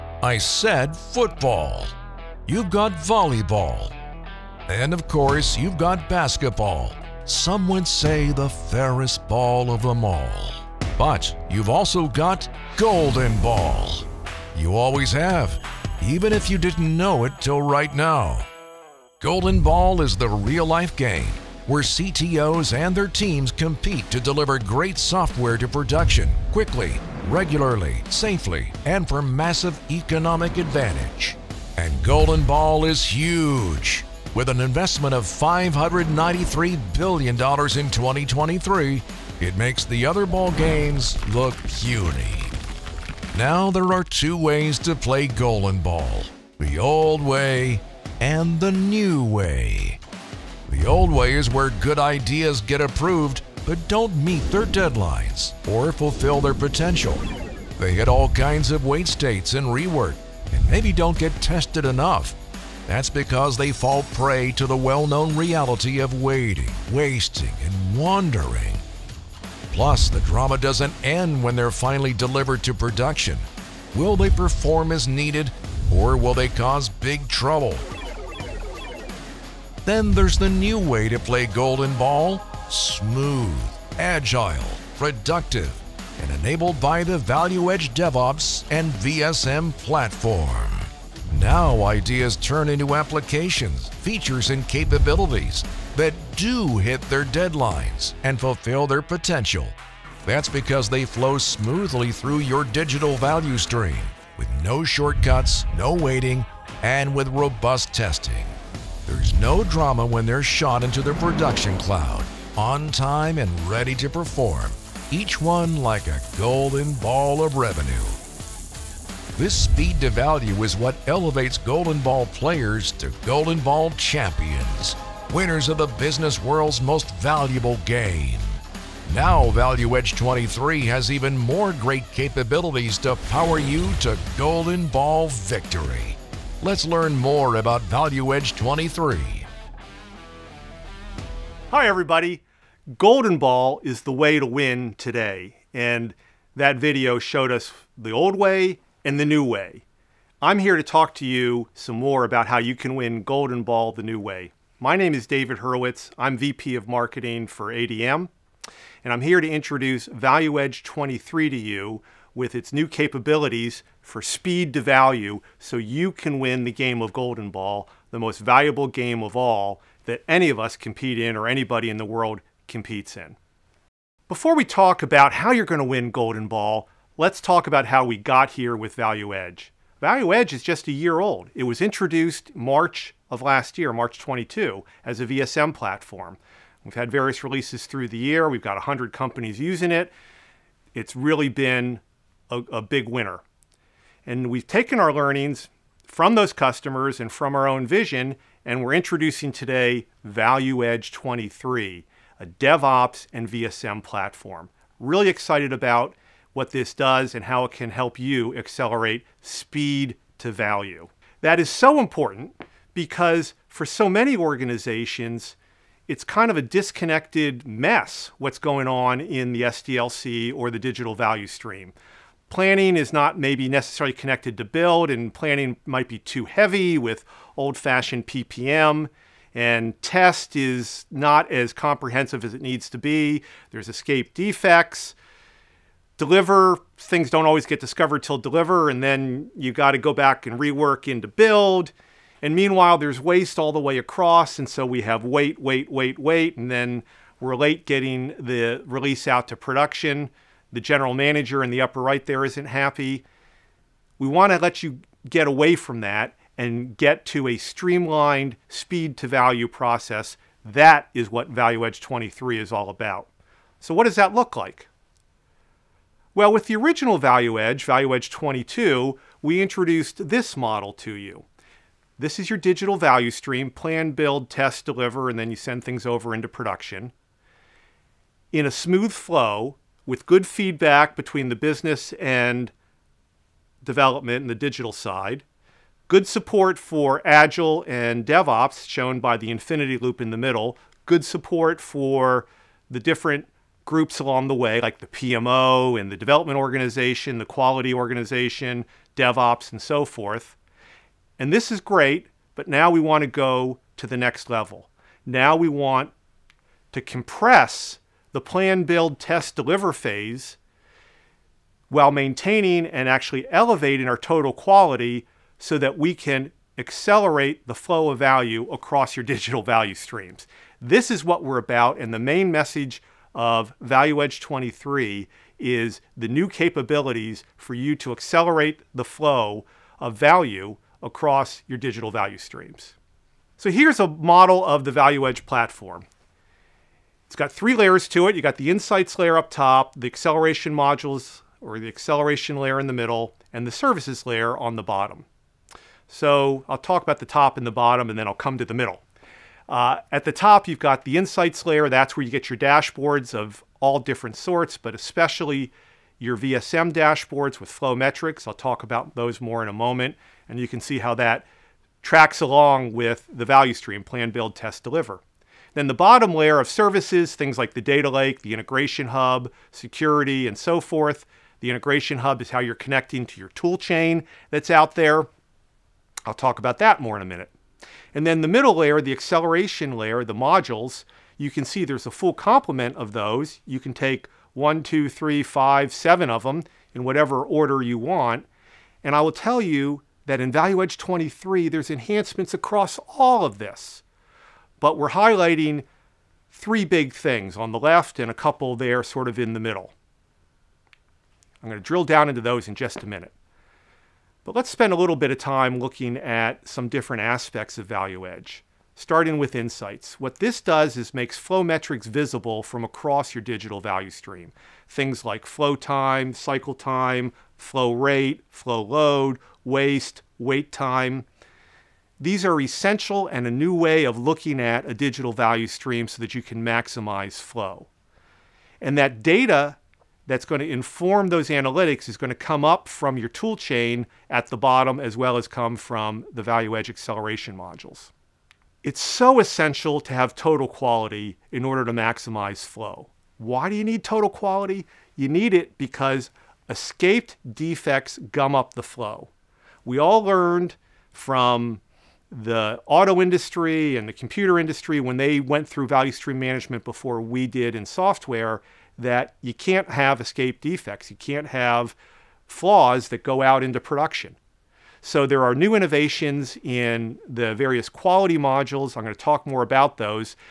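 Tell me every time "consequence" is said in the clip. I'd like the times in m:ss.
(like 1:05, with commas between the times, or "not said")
not said.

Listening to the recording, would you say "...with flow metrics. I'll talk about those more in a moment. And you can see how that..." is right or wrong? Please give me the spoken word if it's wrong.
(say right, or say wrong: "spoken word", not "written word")
right.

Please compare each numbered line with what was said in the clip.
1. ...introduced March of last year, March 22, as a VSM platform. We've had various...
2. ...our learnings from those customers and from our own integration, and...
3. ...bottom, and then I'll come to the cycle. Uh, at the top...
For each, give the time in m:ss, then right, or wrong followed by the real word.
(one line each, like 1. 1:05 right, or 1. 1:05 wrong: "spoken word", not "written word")
1. 3:01 right
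2. 3:14 wrong: "vision", not "integration"
3. 5:47 wrong: "middle", not "cycle".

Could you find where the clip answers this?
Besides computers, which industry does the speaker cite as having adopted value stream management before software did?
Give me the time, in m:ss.
7:32.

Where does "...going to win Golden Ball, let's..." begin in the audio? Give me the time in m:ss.
2:55.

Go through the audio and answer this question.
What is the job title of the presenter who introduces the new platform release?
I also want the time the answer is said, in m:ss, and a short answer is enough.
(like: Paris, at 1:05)
VP of Marketing, at 2:36.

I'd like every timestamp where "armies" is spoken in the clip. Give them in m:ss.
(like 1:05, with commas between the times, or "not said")
not said.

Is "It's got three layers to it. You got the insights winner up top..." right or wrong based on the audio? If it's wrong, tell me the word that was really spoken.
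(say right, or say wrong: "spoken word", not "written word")
wrong: "layer", not "winner".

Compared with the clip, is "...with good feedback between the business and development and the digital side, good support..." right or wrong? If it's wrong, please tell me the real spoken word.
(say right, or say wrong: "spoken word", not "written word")
right.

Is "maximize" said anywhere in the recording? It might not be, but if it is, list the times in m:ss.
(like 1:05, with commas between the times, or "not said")
7:06, 7:21.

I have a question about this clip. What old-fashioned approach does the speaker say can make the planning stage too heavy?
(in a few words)
PPM.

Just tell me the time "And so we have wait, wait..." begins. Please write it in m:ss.
4:04.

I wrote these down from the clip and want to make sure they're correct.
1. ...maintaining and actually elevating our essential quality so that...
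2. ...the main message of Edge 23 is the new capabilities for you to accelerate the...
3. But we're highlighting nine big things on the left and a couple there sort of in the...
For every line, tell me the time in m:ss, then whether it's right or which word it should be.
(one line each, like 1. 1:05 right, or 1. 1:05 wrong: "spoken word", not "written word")
1. 5:12 wrong: "total", not "essential"
2. 5:22 wrong: "ValueEdge", not "Edge"
3. 6:34 wrong: "three", not "nine".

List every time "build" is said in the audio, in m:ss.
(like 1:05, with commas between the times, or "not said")
3:44, 4:01, 4:34, 5:08, 6:04.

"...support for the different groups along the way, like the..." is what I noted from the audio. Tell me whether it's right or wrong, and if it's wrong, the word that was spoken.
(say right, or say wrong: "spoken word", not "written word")
right.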